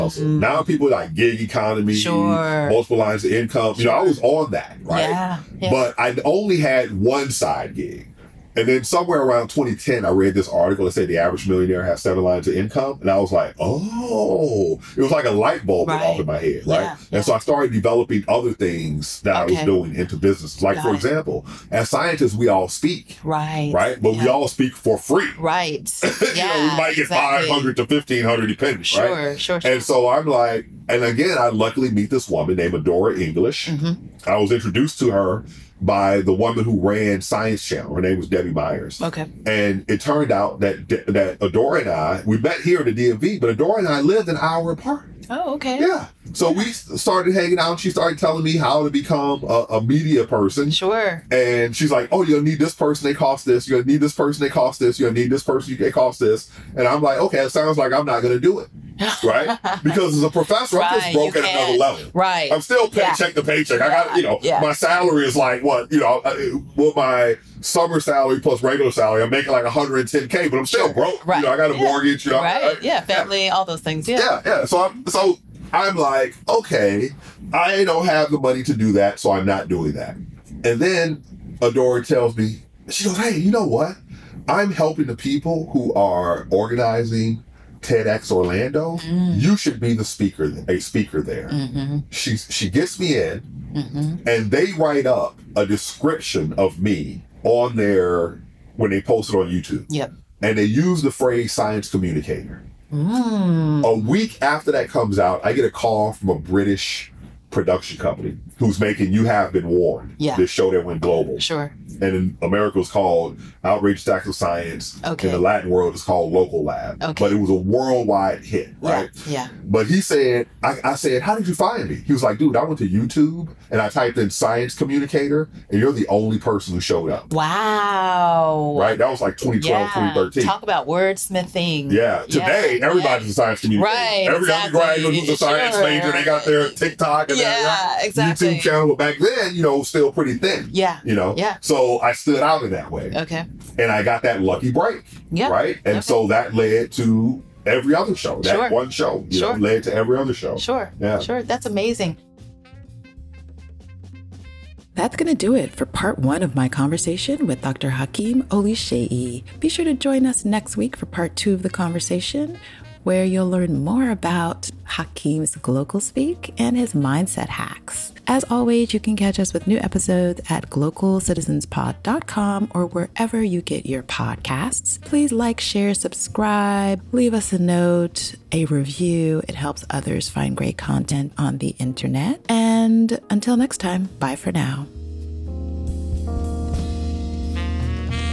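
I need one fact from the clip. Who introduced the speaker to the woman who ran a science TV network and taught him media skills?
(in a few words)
Debbie Myers.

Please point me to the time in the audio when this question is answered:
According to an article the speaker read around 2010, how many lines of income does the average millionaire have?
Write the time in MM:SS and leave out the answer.
00:12.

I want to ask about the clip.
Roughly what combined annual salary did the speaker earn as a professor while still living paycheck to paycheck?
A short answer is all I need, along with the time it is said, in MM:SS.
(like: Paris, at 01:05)
110k, at 01:09.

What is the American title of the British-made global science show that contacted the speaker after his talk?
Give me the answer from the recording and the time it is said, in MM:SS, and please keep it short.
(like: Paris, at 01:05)
Outrageous Acts of Science, at 01:53.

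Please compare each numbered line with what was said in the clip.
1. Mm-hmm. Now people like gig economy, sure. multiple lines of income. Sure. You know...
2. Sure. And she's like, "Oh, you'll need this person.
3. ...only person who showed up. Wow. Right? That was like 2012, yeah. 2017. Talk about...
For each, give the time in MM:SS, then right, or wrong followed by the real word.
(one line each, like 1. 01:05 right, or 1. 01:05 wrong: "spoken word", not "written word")
1. 00:00 right
2. 00:50 right
3. 02:06 wrong: "2013", not "2017".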